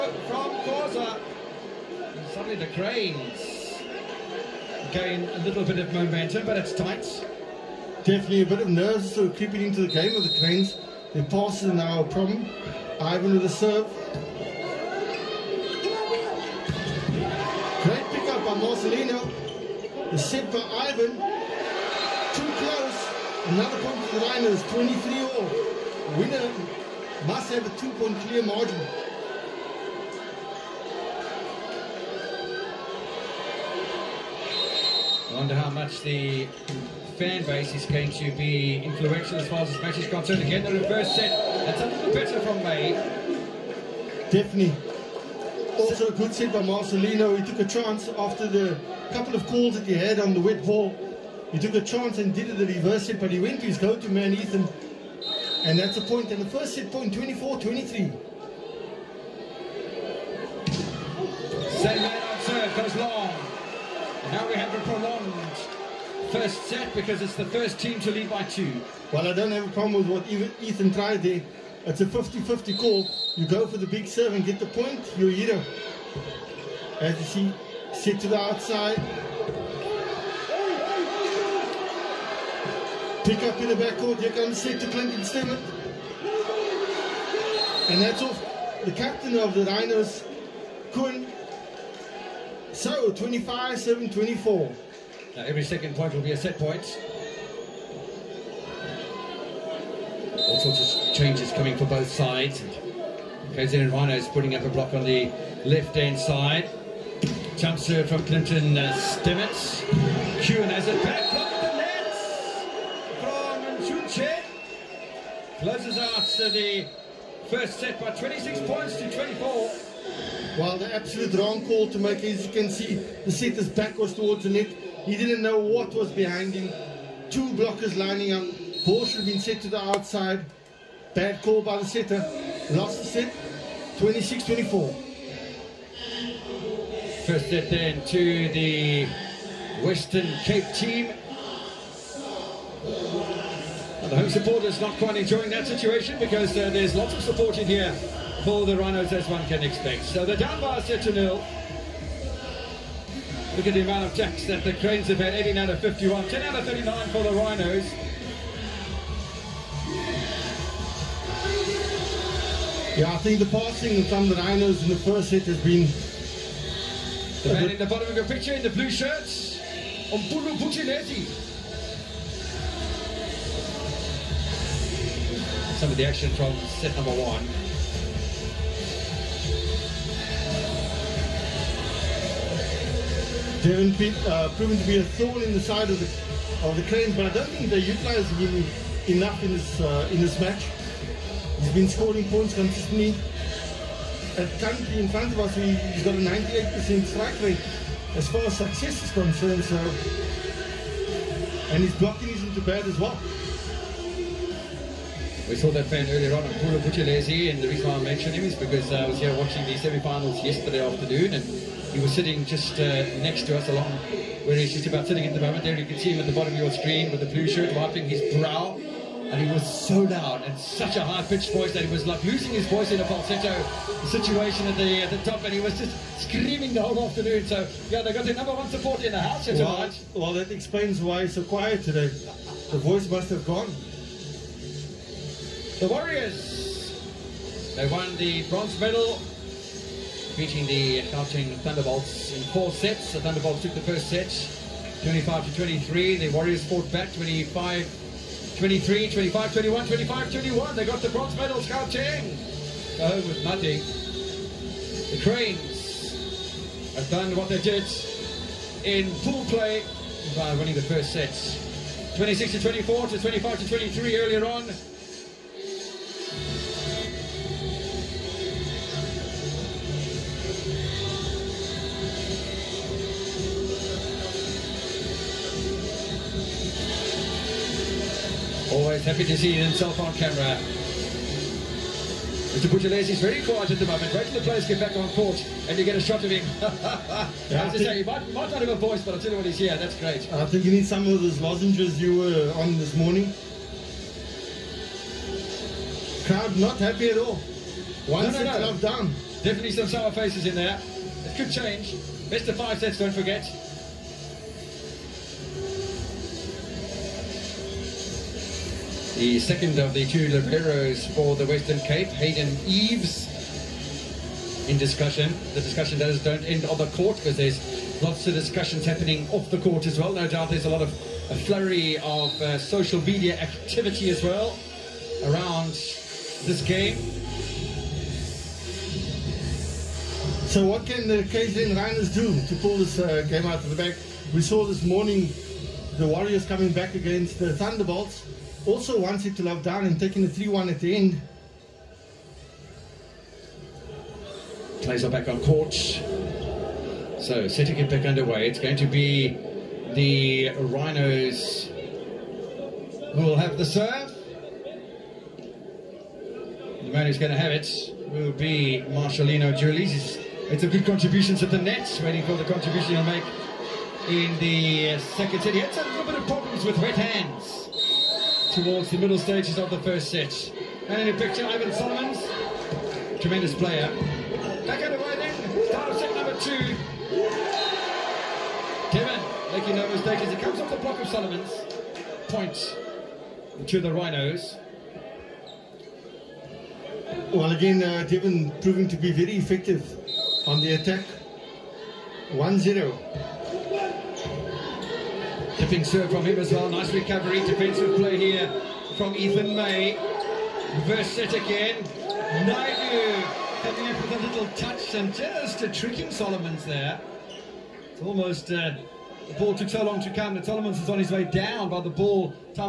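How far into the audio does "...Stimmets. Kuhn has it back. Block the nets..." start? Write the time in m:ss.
1:48.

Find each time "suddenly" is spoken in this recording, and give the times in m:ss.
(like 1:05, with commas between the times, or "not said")
0:02.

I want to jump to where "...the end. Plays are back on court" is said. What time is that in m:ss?
5:40.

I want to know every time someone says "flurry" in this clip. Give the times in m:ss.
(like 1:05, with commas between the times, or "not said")
5:21.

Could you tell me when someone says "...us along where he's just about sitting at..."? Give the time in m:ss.
3:33.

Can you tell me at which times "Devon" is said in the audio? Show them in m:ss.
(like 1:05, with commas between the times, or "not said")
3:03, 6:28.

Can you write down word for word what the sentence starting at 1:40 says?
All sorts changes coming for both sides.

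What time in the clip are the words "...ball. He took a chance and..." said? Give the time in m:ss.
0:50.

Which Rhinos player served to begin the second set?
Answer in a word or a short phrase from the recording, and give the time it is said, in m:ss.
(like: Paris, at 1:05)
Marcelino Julies, at 5:58.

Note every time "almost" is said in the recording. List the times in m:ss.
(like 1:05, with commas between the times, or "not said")
6:48.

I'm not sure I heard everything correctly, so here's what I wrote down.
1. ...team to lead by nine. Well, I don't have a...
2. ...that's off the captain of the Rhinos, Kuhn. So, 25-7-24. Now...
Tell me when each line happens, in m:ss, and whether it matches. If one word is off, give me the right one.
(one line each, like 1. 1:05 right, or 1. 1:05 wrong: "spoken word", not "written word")
1. 1:07 wrong: "two", not "nine"
2. 1:28 right.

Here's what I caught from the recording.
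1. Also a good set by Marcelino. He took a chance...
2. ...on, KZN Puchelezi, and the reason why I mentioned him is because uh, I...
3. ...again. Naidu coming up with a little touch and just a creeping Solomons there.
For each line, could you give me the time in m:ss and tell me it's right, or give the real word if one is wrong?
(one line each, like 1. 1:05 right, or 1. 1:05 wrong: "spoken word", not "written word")
1. 0:45 right
2. 3:26 wrong: "Pula", not "KZN"
3. 6:41 wrong: "tricking", not "creeping".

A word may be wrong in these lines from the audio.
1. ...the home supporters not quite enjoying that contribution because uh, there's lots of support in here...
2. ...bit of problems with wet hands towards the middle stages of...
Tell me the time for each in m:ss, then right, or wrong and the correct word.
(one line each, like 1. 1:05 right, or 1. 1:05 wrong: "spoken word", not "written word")
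1. 2:24 wrong: "situation", not "contribution"
2. 6:06 right.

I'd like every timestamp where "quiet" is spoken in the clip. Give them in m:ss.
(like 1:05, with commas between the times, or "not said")
3:51, 4:43.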